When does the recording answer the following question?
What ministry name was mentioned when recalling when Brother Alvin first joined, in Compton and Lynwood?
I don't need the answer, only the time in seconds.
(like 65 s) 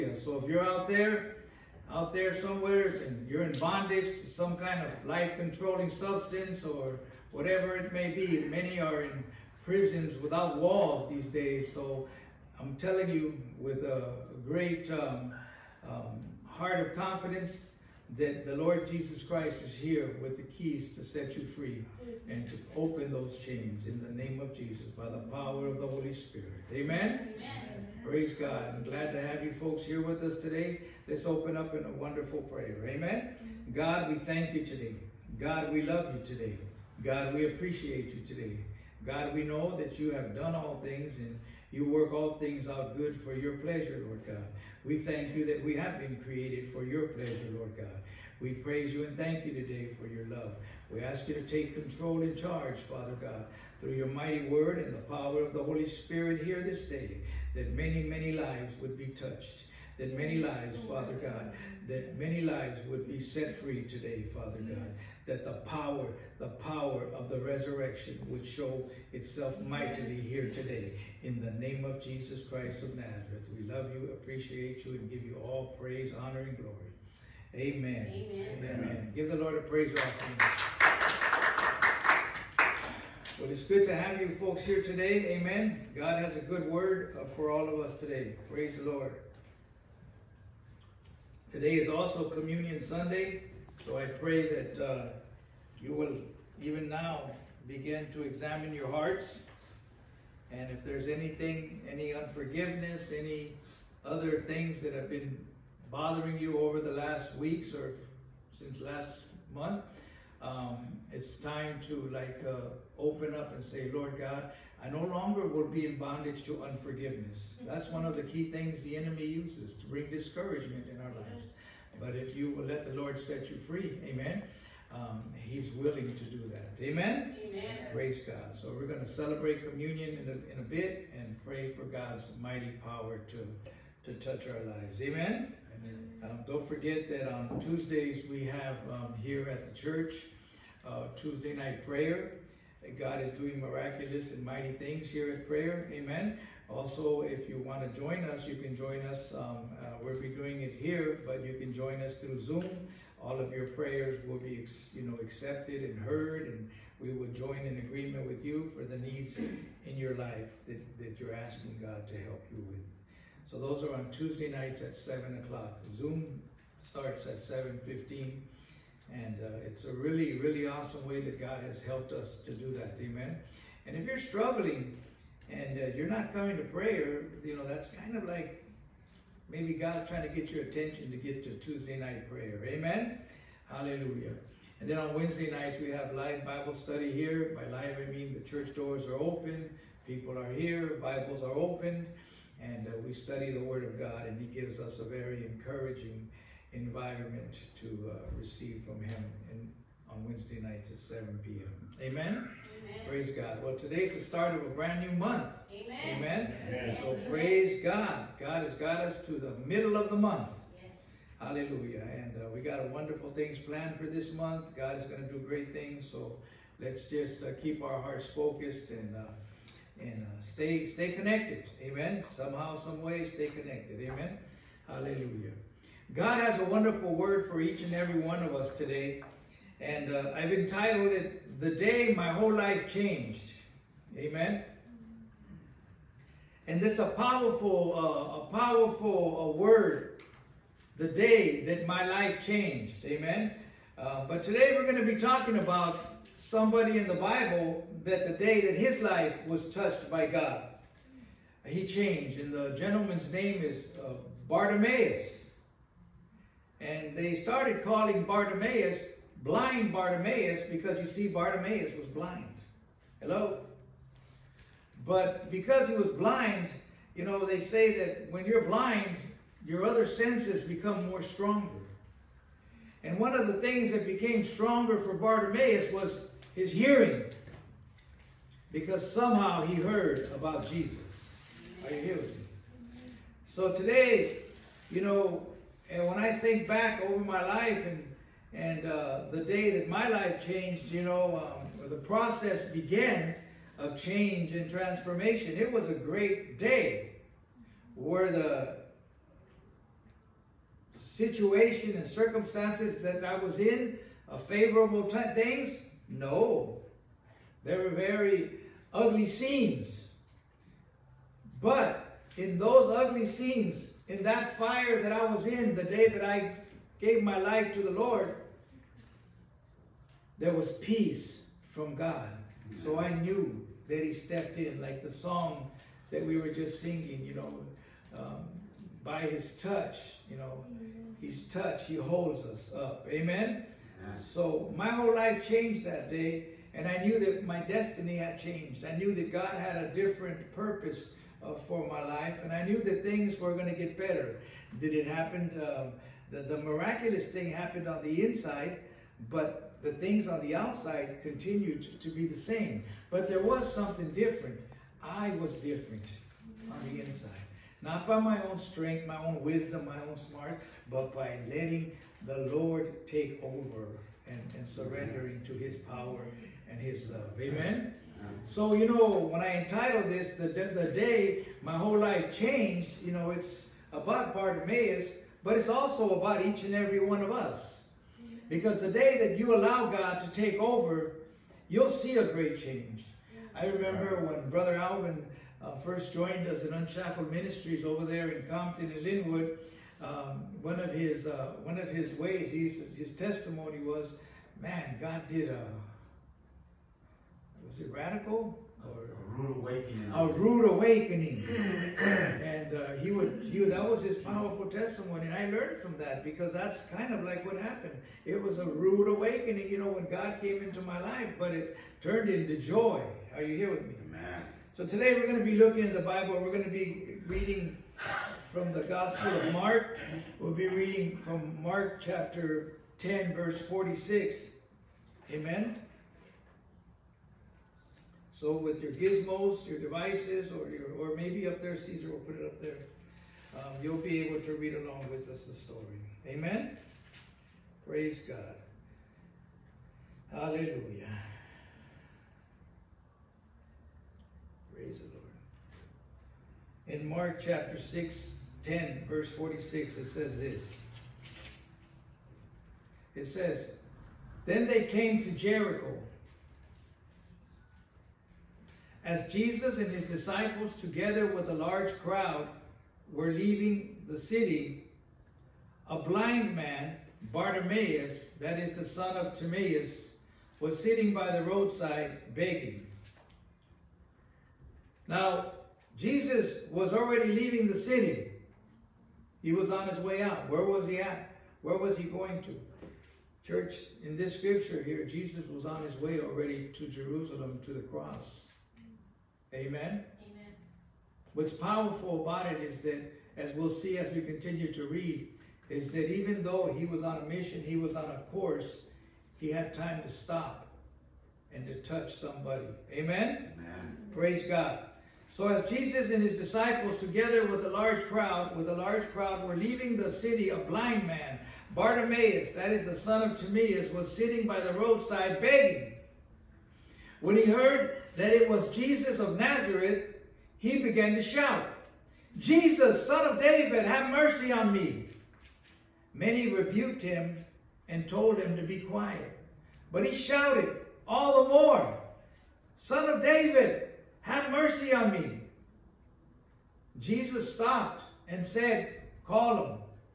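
386 s.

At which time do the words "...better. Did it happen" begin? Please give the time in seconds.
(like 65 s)
343 s.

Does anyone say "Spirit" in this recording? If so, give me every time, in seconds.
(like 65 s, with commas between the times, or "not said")
26 s, 55 s.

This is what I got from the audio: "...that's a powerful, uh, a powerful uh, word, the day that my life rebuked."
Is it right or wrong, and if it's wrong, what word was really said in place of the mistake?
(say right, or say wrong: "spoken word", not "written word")
wrong: "changed", not "rebuked".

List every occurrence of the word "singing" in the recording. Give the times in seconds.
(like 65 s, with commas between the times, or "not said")
326 s.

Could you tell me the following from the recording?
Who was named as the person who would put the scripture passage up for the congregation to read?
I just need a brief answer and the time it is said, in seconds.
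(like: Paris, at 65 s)
Caesar, at 431 s.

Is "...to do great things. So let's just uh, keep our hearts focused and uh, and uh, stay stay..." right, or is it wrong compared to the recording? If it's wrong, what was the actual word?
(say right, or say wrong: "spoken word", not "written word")
right.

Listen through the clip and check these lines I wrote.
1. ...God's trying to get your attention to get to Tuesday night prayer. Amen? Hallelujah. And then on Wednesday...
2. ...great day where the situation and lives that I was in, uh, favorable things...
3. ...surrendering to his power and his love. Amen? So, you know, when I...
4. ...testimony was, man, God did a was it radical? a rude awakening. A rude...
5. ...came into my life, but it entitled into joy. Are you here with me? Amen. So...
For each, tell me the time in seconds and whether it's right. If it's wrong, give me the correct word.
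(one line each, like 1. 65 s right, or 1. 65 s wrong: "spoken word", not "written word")
1. 179 s right
2. 295 s wrong: "circumstances", not "lives"
3. 364 s right
4. 393 s right
5. 410 s wrong: "turned", not "entitled".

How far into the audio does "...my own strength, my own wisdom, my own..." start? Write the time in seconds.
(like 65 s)
358 s.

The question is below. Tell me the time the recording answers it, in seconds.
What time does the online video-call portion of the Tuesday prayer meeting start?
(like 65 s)
167 s.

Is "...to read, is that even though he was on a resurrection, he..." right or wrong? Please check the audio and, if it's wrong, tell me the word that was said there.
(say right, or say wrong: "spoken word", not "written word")
wrong: "mission", not "resurrection".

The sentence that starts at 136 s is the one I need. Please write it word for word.
Um, don't forget that on Tuesdays we have um, here at the church uh, Tuesday night prayer.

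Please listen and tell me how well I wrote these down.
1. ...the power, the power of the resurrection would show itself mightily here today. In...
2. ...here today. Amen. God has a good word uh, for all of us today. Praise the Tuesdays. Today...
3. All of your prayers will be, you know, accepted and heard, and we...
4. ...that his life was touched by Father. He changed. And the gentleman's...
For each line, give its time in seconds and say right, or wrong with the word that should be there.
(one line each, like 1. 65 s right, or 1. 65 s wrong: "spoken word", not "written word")
1. 65 s right
2. 84 s wrong: "Lord", not "Tuesdays"
3. 153 s right
4. 248 s wrong: "God", not "Father".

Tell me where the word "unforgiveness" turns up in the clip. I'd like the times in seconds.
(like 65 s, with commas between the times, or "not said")
102 s, 116 s.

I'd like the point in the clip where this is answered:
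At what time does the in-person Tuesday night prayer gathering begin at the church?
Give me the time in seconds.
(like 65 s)
164 s.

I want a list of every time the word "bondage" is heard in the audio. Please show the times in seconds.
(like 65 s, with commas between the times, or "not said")
3 s, 115 s.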